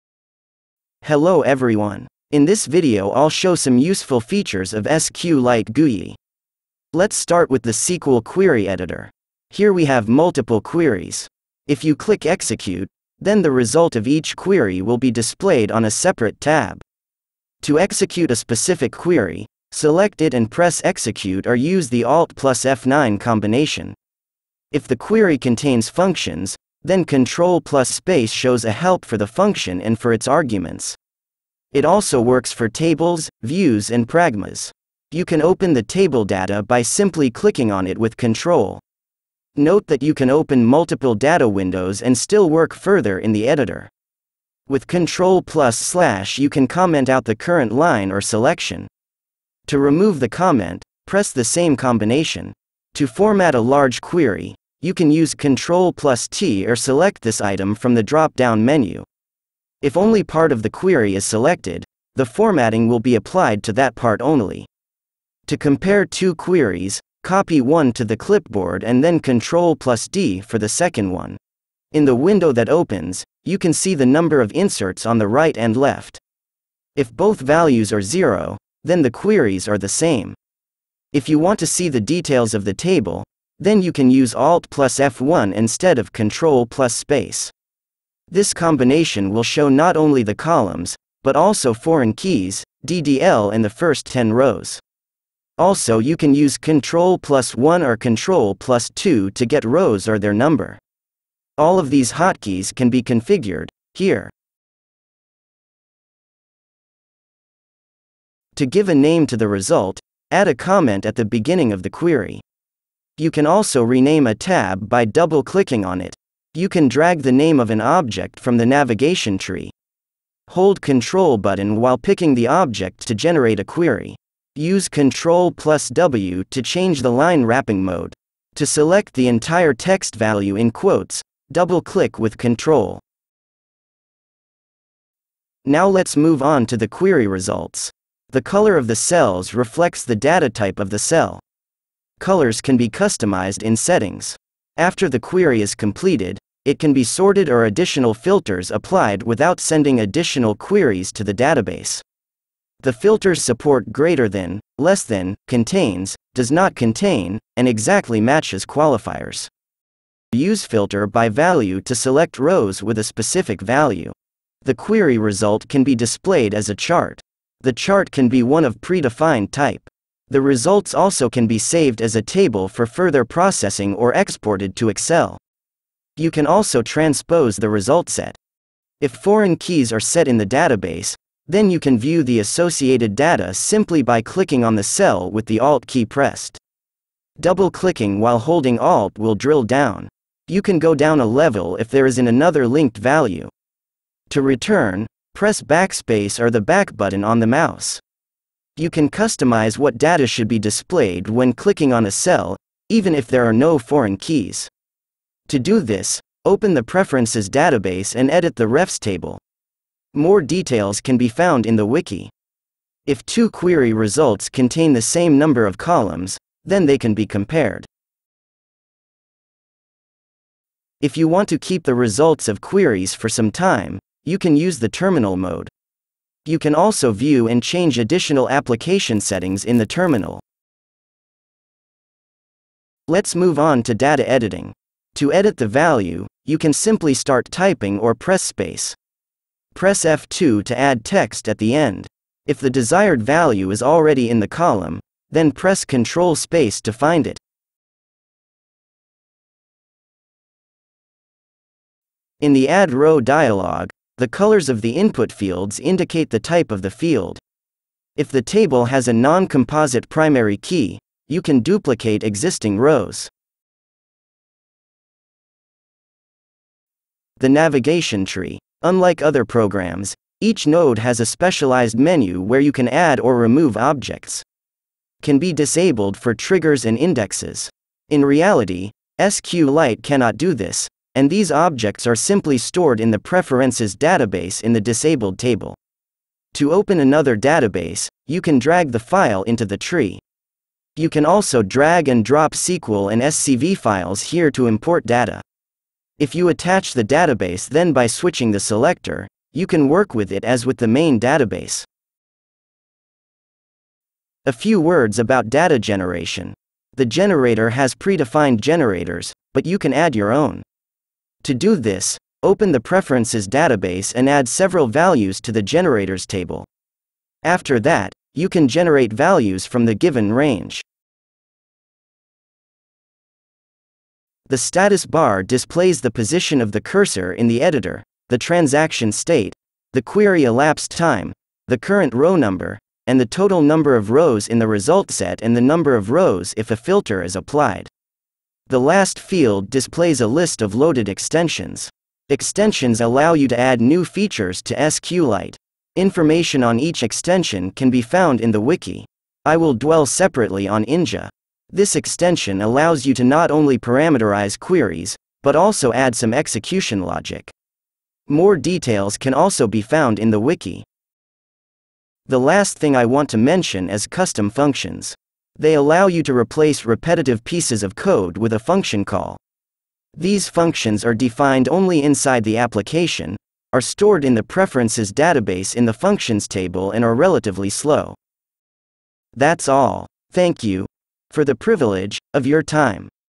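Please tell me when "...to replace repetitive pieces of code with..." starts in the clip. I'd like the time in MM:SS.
06:06.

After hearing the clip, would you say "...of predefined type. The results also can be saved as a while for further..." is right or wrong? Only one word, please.
wrong.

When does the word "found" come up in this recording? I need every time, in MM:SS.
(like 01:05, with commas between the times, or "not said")
03:31, 05:48, 05:59.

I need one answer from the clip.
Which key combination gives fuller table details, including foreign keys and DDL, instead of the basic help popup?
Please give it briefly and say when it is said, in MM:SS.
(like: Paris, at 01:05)
Alt+F1, at 01:24.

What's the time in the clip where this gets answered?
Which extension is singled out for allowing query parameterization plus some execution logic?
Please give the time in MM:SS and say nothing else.
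05:50.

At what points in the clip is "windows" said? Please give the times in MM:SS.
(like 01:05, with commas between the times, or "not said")
00:41, 01:12.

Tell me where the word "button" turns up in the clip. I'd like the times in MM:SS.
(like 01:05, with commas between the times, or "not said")
02:01, 03:16.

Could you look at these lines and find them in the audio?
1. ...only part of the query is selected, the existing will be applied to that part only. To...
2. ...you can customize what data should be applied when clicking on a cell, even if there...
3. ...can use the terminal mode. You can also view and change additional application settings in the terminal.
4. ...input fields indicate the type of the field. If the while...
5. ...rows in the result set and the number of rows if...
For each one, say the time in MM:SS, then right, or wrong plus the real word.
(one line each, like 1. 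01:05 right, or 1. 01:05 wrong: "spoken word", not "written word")
1. 00:59 wrong: "formatting", not "existing"
2. 03:18 wrong: "displayed", not "applied"
3. 03:44 right
4. 04:14 wrong: "table", not "while"
5. 05:34 right.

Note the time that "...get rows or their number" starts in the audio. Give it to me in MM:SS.
01:39.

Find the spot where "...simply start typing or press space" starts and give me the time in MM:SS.
03:56.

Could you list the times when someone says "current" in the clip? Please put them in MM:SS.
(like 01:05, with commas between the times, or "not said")
00:47, 05:31.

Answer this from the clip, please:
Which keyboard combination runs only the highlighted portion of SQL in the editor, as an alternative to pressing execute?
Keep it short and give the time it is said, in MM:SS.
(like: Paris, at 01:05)
Alt+F9, at 00:22.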